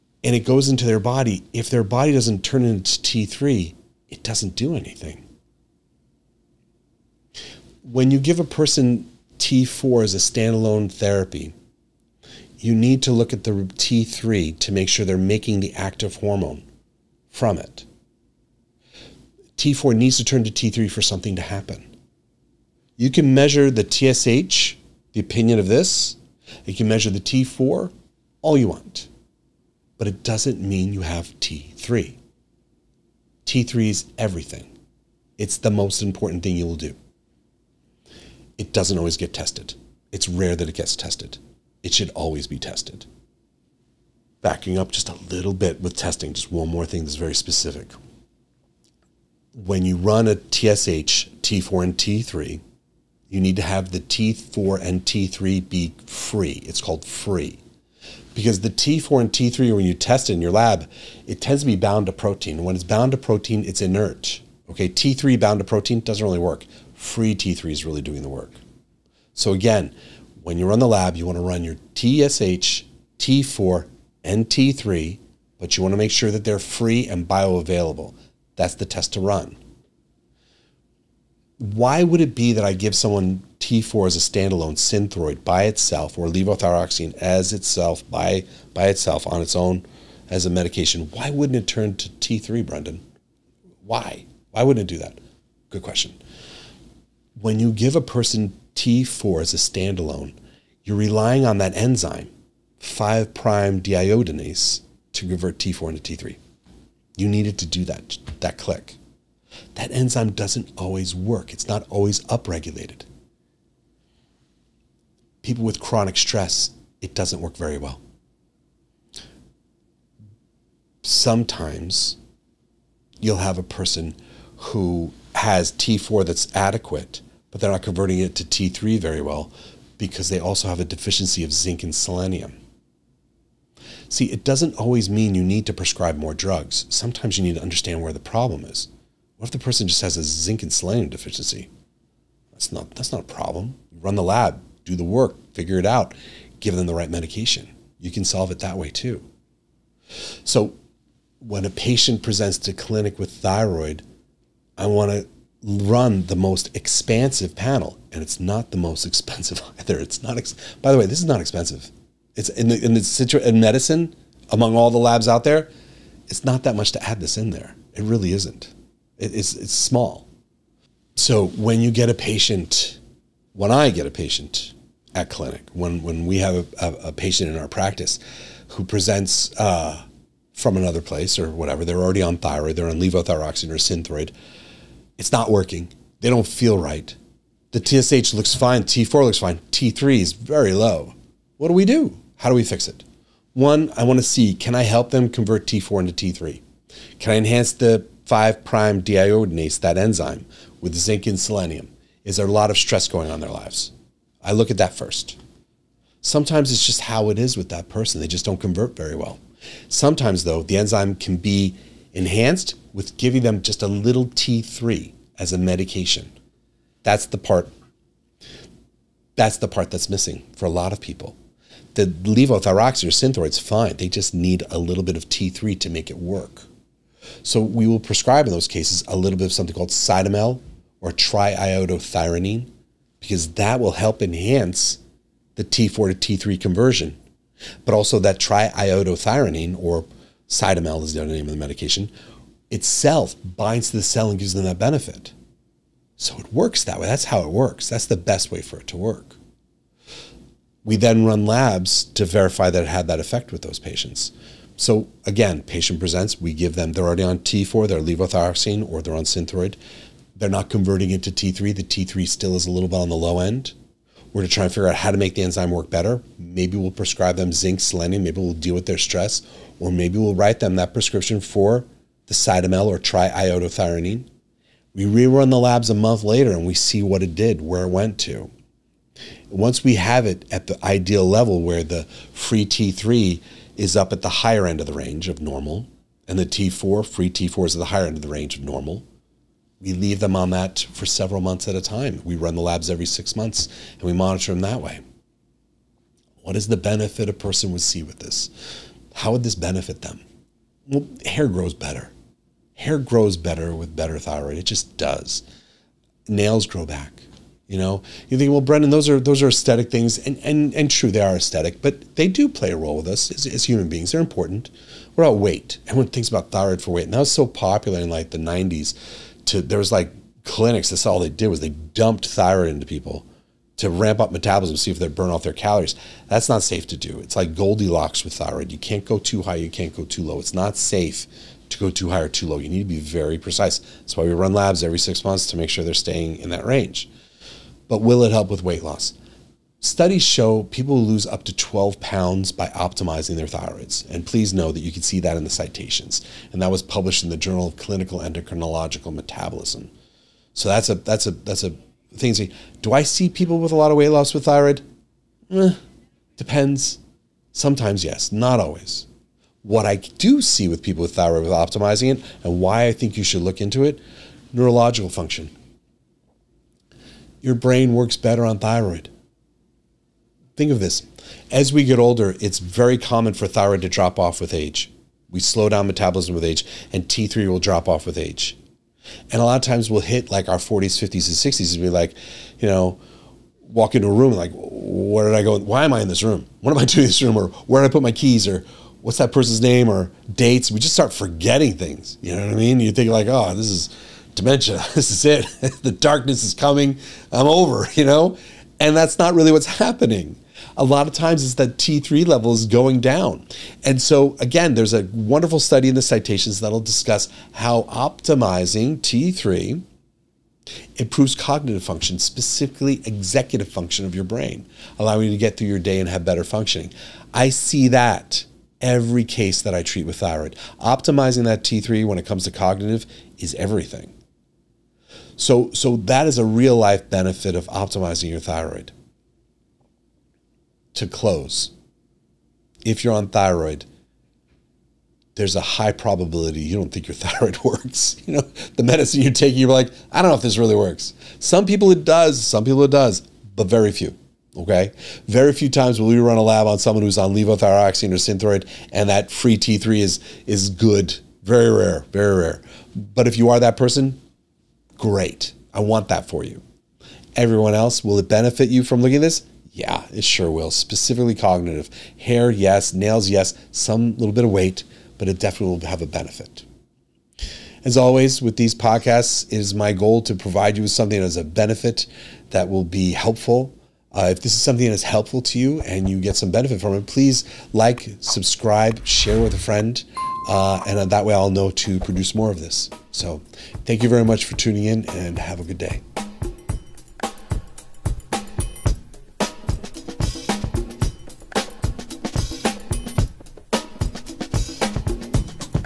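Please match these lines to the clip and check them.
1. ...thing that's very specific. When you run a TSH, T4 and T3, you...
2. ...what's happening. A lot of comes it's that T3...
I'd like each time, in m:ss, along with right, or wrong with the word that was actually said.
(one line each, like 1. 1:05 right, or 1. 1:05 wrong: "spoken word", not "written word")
1. 0:46 right
2. 6:39 wrong: "times", not "comes".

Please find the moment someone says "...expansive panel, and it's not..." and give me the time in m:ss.
2:36.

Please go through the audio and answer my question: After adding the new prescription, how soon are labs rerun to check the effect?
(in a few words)
a month later.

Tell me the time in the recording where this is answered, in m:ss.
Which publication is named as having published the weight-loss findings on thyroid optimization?
5:47.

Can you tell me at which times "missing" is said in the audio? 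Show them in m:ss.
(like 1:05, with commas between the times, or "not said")
3:40.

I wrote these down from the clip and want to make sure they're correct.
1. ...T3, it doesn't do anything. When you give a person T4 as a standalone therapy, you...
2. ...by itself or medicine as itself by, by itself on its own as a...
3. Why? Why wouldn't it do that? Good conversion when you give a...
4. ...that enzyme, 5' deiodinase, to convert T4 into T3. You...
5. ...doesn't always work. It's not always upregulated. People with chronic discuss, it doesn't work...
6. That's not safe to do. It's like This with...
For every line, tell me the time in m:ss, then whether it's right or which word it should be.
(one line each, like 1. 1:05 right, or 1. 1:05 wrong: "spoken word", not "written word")
1. 0:02 right
2. 1:25 wrong: "levothyroxine", not "medicine"
3. 1:33 wrong: "question", not "conversion"
4. 1:41 right
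5. 1:50 wrong: "stress", not "discuss"
6. 5:26 wrong: "Goldilocks", not "This".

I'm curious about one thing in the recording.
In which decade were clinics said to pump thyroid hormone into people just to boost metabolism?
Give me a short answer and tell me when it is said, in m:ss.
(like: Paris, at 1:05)
the '90s, at 5:18.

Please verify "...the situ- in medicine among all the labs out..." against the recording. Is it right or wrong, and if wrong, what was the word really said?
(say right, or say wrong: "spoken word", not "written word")
right.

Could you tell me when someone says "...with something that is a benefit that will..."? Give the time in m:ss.
7:50.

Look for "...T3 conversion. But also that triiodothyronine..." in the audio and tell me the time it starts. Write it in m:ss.
3:56.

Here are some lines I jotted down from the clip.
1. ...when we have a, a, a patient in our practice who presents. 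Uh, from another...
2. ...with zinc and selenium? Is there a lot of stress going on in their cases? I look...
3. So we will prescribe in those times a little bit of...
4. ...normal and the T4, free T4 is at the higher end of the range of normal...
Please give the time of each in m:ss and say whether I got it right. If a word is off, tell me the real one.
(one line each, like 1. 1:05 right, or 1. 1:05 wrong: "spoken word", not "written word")
1. 2:56 right
2. 3:20 wrong: "lives", not "cases"
3. 3:47 wrong: "cases", not "times"
4. 4:45 right.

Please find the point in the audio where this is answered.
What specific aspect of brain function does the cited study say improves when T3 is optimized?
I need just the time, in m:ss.
6:53.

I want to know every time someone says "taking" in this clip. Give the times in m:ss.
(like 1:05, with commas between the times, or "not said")
7:19.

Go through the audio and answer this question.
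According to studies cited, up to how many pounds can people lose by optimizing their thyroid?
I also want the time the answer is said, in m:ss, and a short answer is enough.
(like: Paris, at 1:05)
12 pounds, at 5:41.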